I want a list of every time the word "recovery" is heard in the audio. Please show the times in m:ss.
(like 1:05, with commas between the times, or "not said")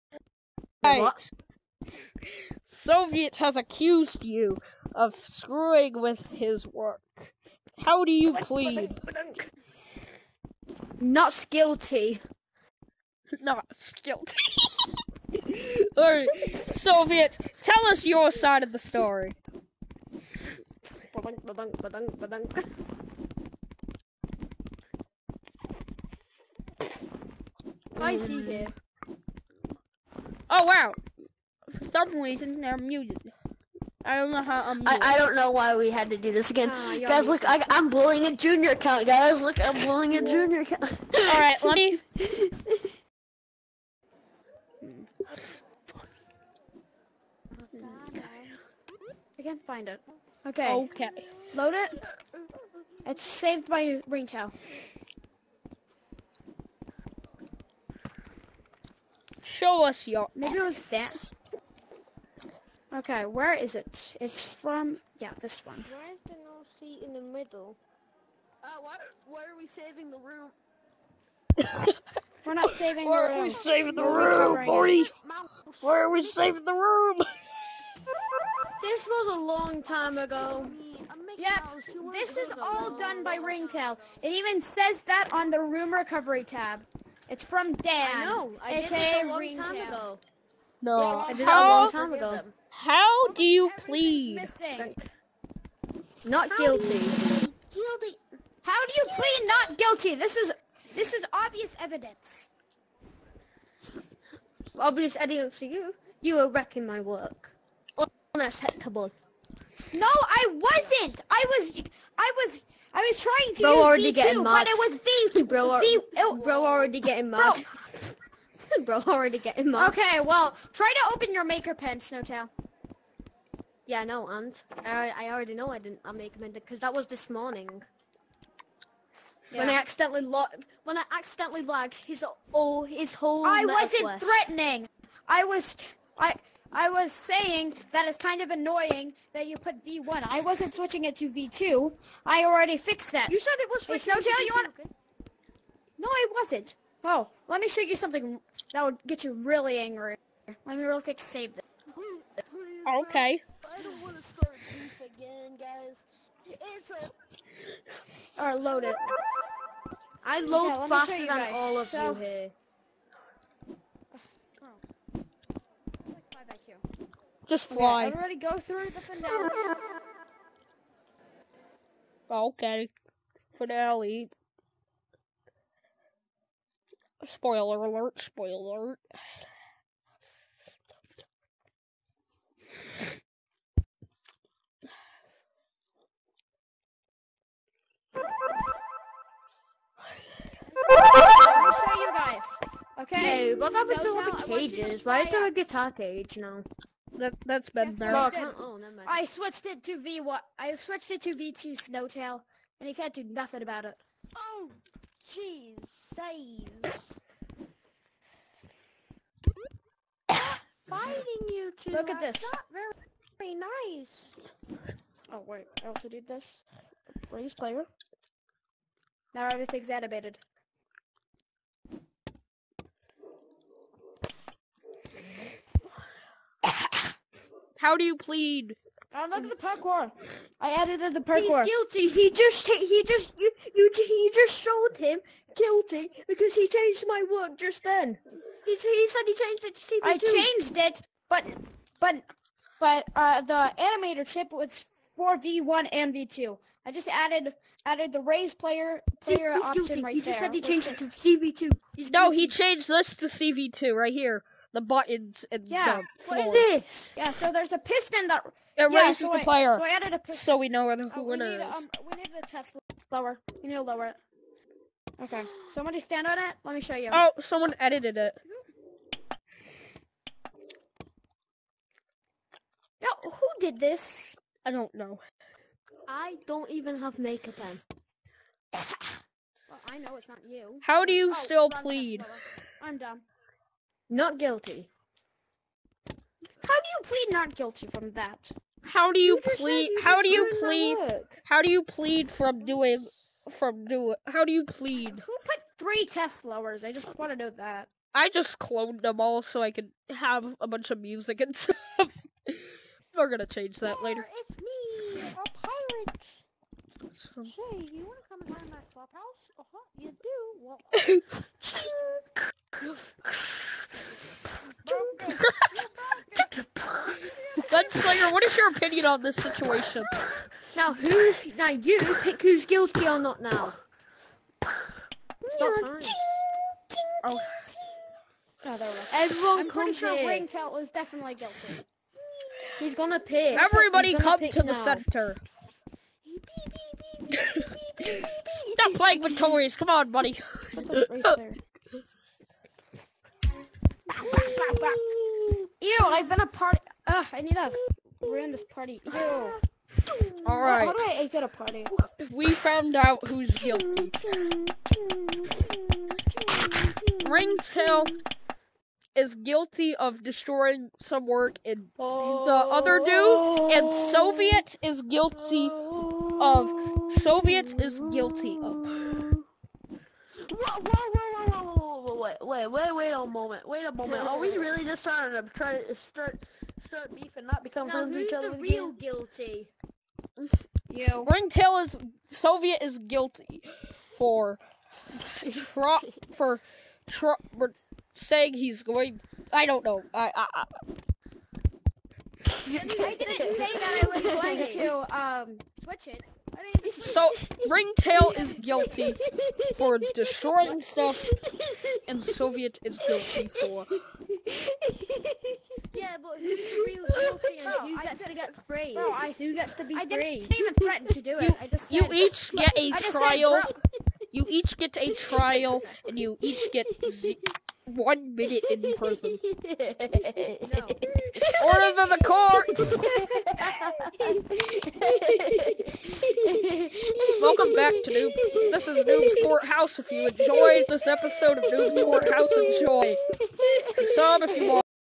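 1:25.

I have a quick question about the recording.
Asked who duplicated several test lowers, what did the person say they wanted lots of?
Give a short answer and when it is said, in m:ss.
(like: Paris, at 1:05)
music, at 5:00.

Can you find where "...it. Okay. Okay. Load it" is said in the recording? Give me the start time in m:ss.
0:49.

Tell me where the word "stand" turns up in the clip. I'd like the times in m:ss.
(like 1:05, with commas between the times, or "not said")
4:25.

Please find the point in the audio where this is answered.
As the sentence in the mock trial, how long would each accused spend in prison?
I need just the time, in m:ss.
6:57.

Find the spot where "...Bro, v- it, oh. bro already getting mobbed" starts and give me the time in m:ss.
1:55.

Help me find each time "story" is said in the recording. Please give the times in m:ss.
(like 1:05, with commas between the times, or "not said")
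0:18.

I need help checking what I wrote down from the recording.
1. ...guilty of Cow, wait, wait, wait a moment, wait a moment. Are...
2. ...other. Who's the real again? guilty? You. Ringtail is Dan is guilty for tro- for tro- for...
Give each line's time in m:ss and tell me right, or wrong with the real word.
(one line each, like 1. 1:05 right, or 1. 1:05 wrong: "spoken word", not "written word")
1. 6:08 wrong: "Wait", not "Cow"
2. 6:18 wrong: "Soviet", not "Dan".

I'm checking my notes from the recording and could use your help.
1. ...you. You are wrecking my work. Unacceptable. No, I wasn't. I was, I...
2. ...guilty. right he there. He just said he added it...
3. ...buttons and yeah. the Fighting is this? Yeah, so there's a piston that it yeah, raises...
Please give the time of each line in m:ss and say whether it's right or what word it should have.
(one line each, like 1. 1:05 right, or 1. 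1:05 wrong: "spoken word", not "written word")
1. 1:45 right
2. 4:09 wrong: "changed", not "added"
3. 4:14 wrong: "What", not "Fighting".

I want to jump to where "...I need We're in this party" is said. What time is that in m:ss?
5:47.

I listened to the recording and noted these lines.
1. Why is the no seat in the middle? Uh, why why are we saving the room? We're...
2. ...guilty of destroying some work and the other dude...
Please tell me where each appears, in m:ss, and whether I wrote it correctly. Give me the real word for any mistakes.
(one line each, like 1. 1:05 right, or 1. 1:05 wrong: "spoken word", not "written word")
1. 1:05 right
2. 5:59 right.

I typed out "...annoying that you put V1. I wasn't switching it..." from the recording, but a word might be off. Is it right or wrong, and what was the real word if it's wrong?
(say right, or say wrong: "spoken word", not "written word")
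right.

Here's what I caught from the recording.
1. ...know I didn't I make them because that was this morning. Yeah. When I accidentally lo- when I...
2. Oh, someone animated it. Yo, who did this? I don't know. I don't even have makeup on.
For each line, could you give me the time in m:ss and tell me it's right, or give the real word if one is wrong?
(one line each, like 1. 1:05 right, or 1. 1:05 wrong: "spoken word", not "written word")
1. 2:05 right
2. 4:27 wrong: "edited", not "animated".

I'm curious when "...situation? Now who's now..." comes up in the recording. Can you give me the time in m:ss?
5:19.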